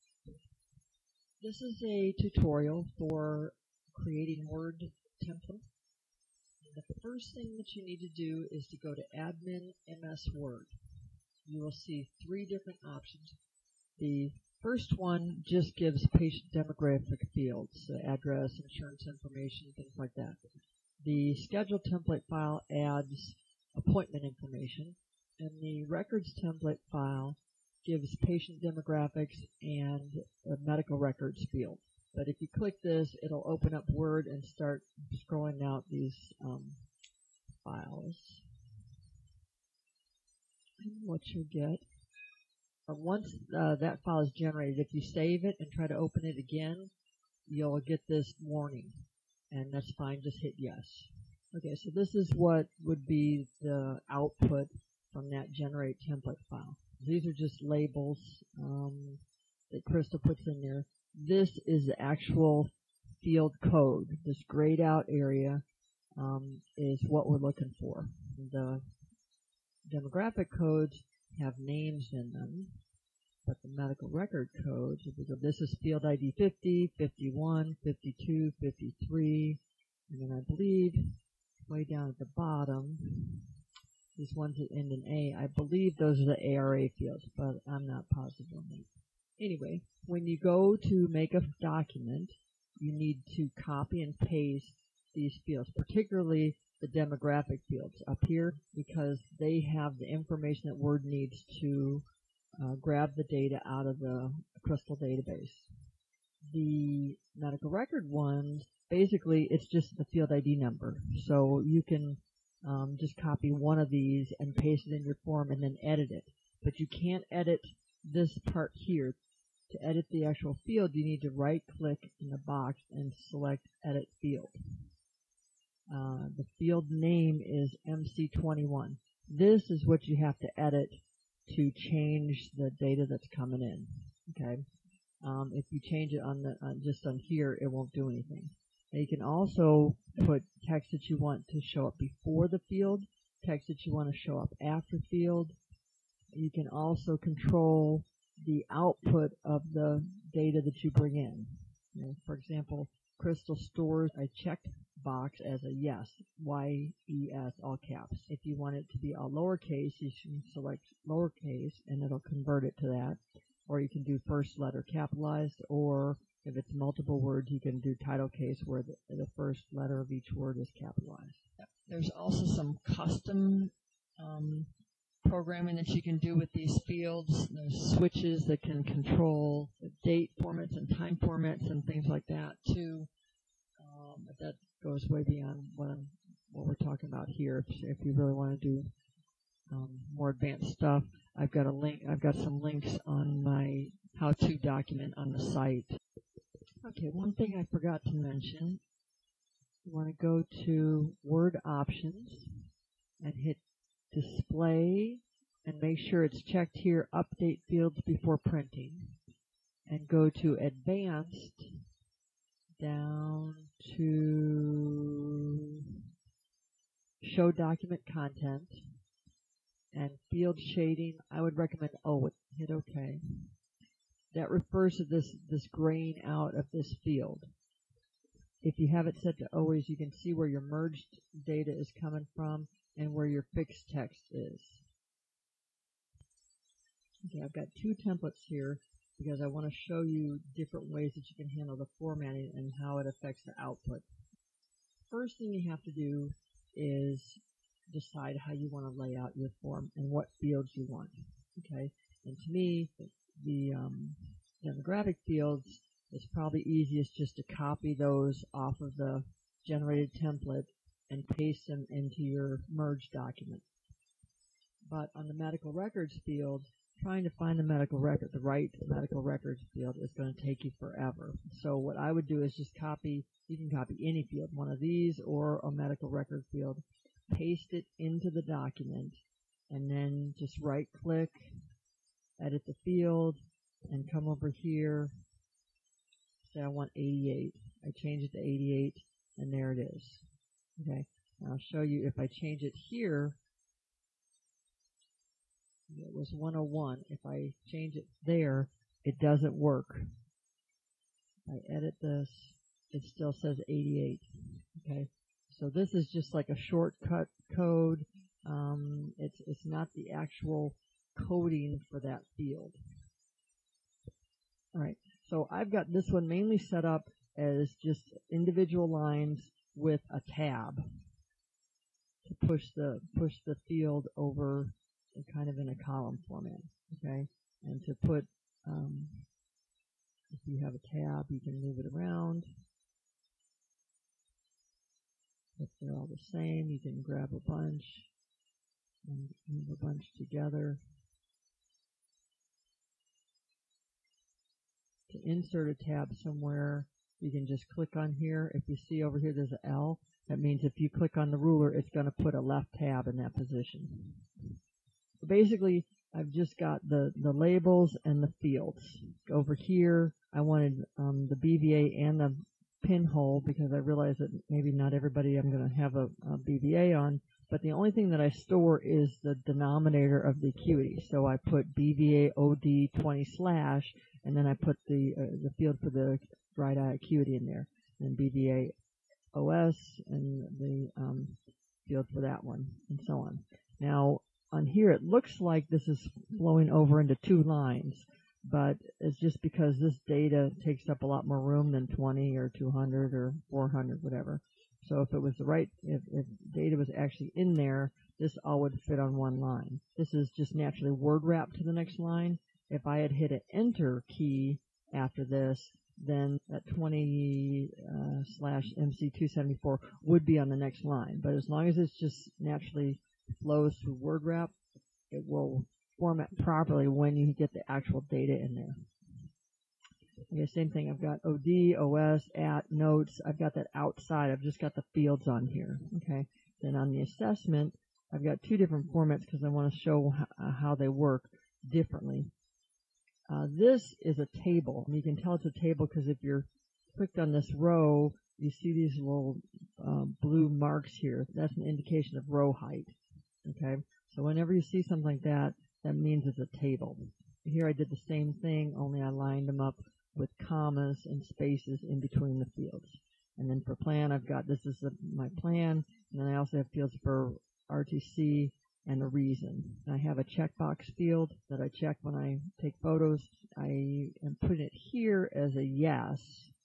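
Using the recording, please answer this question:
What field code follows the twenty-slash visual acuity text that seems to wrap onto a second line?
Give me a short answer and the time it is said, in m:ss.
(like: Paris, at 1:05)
MC274, at 6:48.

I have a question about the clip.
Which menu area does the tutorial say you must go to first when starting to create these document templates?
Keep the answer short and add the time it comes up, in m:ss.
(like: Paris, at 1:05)
Admin MS Word, at 0:09.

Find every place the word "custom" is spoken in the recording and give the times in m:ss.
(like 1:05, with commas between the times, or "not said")
2:52.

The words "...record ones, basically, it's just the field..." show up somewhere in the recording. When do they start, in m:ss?
1:47.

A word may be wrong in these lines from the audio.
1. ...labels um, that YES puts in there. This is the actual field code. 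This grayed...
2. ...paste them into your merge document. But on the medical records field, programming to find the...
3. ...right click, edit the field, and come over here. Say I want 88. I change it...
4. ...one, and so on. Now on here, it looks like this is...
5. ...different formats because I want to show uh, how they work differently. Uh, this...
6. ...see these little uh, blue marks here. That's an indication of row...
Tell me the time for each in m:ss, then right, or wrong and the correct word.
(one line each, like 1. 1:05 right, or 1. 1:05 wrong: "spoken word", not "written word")
1. 0:57 wrong: "Crystal", not "YES"
2. 4:21 wrong: "trying", not "programming"
3. 4:40 right
4. 6:22 right
5. 7:08 right
6. 7:18 right.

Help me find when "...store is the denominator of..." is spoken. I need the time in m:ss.
6:08.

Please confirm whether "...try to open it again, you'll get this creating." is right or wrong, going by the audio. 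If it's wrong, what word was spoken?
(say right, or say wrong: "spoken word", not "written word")
wrong: "warning", not "creating".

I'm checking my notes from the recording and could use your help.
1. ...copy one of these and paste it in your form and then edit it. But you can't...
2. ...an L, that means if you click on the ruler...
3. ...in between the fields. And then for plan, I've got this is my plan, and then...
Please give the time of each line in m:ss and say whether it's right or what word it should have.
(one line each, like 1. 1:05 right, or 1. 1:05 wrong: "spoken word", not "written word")
1. 1:53 right
2. 5:49 right
3. 7:31 right.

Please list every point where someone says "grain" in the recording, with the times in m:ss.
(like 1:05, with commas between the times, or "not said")
3:45.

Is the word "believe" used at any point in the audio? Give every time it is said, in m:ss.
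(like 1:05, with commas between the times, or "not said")
1:20, 1:25.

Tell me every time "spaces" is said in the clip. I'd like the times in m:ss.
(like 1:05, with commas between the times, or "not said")
7:31.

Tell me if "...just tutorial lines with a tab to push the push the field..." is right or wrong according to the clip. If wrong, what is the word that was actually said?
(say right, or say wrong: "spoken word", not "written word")
wrong: "individual", not "tutorial".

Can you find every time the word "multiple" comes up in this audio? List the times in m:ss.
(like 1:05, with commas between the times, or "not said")
2:46.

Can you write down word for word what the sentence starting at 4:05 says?
First thing you have to do is decide how you want to lay out your form and what fields you want.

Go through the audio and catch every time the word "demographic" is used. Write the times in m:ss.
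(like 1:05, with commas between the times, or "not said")
0:16, 0:28, 1:09, 1:36, 4:14.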